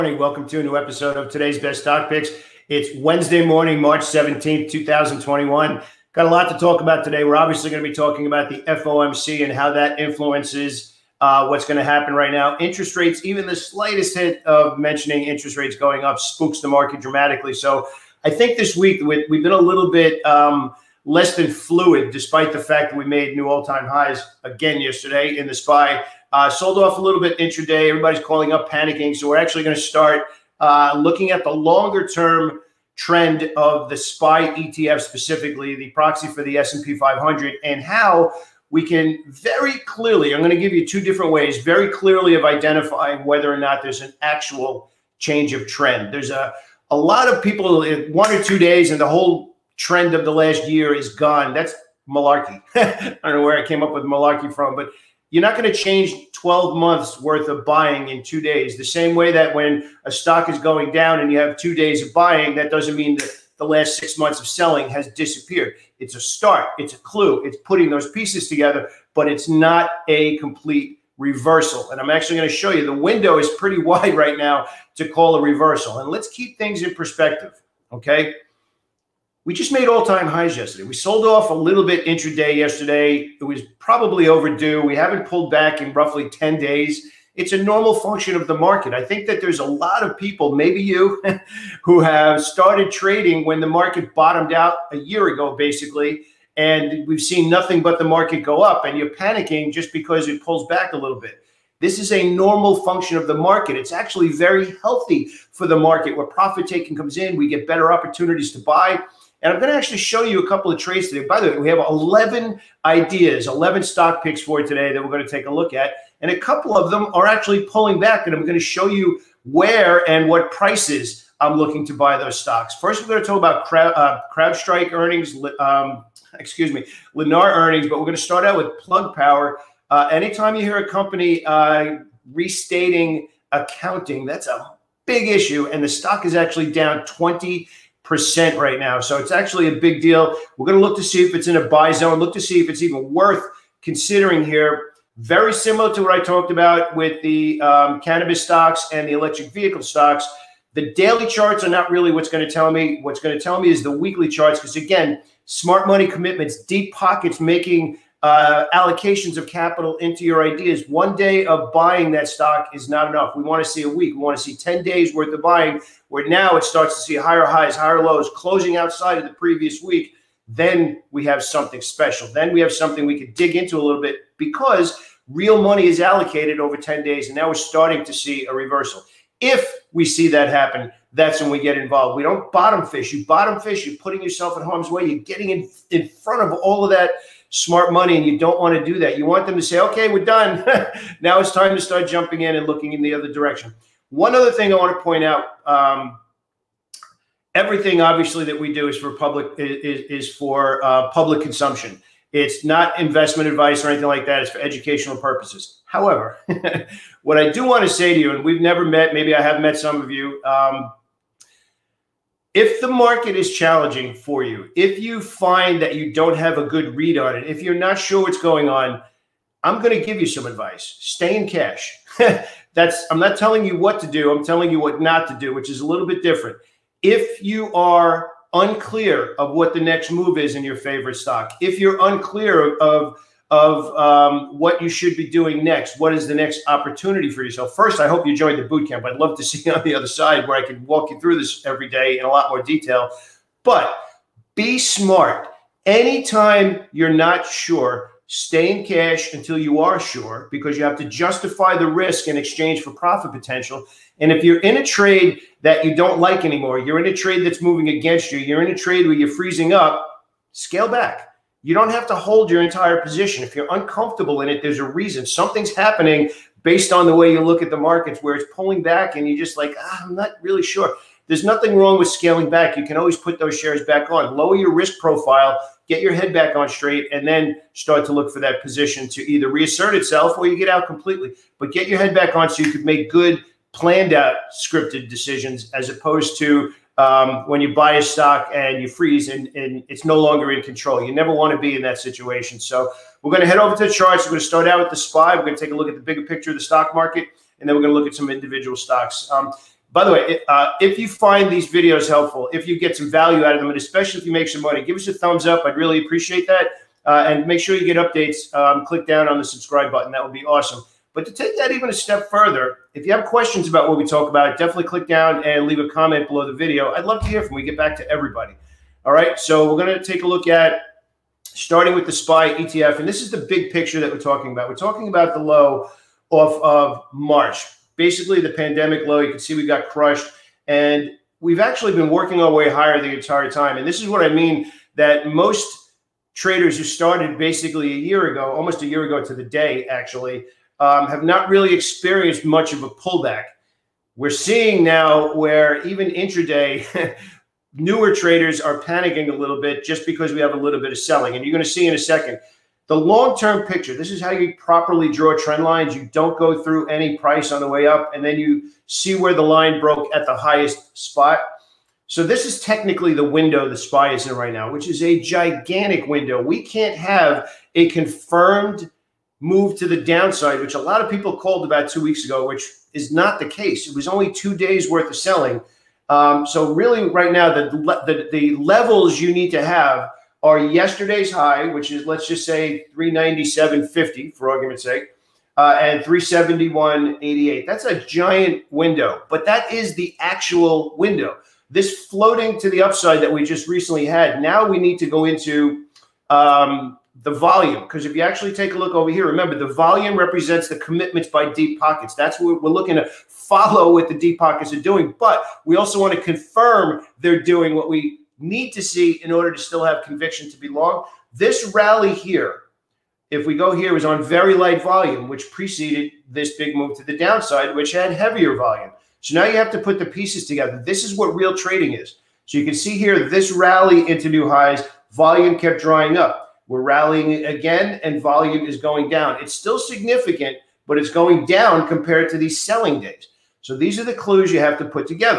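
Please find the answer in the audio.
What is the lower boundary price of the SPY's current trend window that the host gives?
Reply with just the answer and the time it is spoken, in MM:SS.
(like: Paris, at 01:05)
371.88, at 06:26.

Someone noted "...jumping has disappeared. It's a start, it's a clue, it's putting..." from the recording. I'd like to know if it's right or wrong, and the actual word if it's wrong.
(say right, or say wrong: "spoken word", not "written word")
wrong: "selling", not "jumping".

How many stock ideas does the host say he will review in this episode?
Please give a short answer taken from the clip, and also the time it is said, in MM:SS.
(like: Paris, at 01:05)
11, at 01:53.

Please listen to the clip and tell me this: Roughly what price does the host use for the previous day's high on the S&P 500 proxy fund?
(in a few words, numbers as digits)
397.50.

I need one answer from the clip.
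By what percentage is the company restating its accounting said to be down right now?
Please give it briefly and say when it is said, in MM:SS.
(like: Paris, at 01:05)
20 percent, at 02:17.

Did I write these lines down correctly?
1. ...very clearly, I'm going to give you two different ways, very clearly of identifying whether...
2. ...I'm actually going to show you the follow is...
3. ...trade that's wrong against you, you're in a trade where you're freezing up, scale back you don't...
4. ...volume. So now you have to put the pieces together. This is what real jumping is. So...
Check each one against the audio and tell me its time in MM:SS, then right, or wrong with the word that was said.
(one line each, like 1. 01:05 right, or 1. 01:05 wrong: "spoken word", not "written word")
1. 00:39 right
2. 01:11 wrong: "window", not "follow"
3. 04:17 wrong: "moving", not "wrong"
4. 06:58 wrong: "trading", not "jumping".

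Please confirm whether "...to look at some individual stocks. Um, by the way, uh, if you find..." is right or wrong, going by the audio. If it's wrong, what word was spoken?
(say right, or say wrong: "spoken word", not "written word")
right.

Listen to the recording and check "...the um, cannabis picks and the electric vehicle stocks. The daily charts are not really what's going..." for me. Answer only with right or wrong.
wrong.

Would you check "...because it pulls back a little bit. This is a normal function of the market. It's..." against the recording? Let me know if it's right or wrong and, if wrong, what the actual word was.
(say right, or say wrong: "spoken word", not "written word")
right.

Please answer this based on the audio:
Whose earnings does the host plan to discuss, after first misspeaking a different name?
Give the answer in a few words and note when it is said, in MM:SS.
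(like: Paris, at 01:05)
Lennar, at 02:07.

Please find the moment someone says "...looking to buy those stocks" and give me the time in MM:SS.
02:01.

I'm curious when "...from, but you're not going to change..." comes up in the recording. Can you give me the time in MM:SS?
00:54.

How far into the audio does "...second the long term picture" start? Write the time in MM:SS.
05:51.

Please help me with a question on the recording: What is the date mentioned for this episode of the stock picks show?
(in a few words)
March 17th, 2021.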